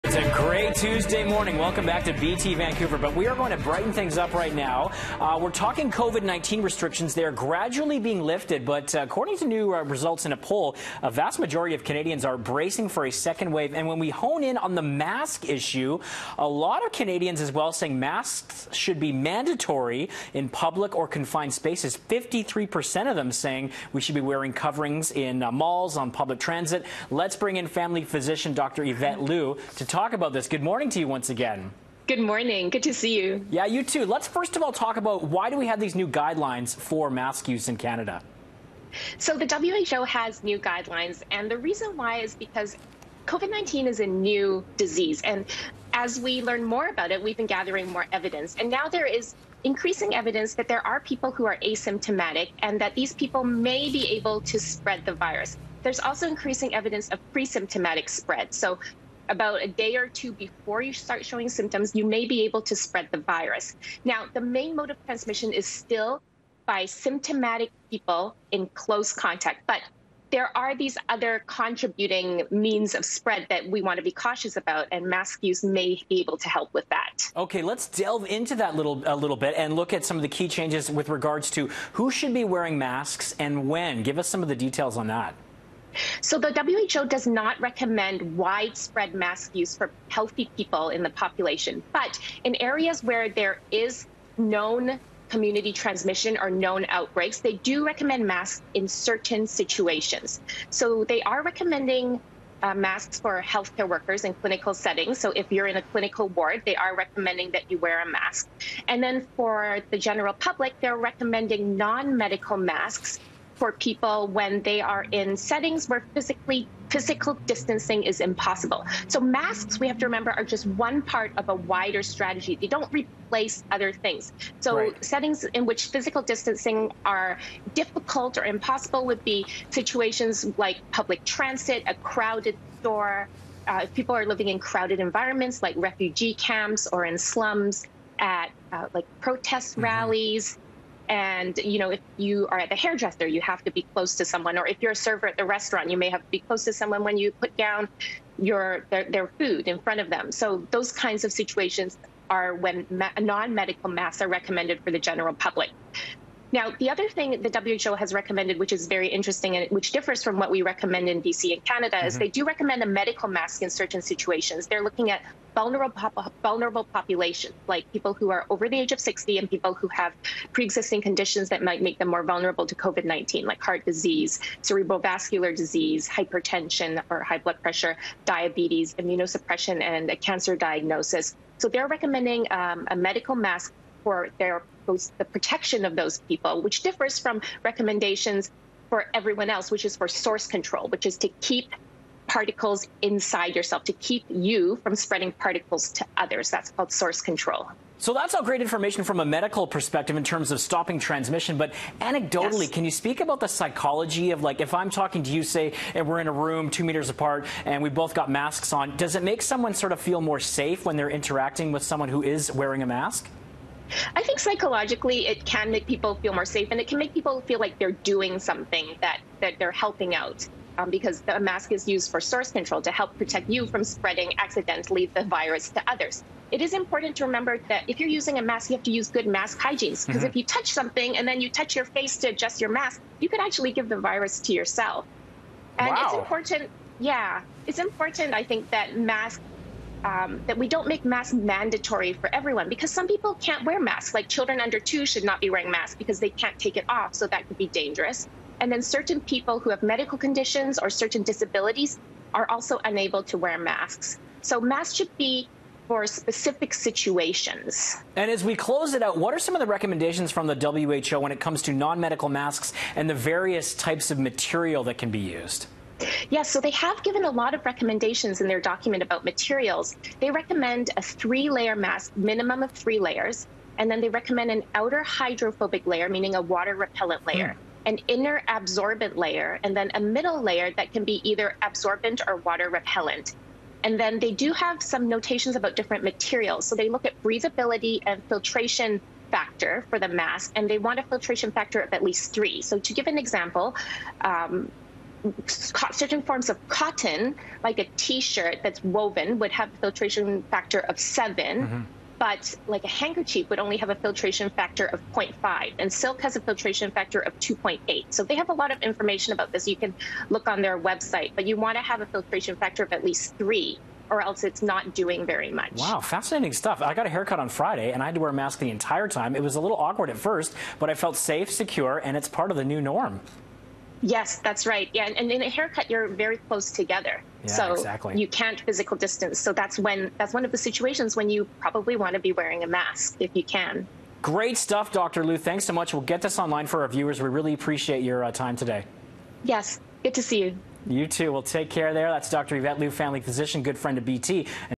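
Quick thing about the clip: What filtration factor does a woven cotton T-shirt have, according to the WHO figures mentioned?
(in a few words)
7.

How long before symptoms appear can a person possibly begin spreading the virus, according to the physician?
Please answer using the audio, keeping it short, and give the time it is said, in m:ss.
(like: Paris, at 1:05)
a day or two, at 0:59.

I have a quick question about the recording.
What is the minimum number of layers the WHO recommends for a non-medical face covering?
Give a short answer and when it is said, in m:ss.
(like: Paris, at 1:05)
3, at 4:32.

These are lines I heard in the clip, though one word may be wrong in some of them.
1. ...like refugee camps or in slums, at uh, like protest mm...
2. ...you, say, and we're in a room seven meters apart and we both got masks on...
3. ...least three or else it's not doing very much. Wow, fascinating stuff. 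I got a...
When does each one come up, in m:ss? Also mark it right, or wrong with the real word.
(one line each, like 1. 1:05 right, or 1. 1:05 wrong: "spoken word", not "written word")
1. 2:15 right
2. 3:25 wrong: "two", not "seven"
3. 5:13 right.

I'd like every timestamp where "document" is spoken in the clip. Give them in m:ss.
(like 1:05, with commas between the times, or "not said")
4:28.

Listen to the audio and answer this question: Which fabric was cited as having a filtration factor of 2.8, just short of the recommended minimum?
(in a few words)
silk.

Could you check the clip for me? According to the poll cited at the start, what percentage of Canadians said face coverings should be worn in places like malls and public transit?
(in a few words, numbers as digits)
53%.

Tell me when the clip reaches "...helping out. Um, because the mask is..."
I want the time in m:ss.
3:39.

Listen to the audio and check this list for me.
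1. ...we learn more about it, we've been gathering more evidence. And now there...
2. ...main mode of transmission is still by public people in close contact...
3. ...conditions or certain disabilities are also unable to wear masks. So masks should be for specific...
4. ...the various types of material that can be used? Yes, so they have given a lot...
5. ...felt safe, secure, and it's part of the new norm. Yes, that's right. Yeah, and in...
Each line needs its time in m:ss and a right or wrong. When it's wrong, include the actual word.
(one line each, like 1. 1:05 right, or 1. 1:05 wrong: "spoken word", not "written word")
1. 0:46 right
2. 1:04 wrong: "symptomatic", not "public"
3. 4:10 right
4. 4:23 right
5. 5:20 right.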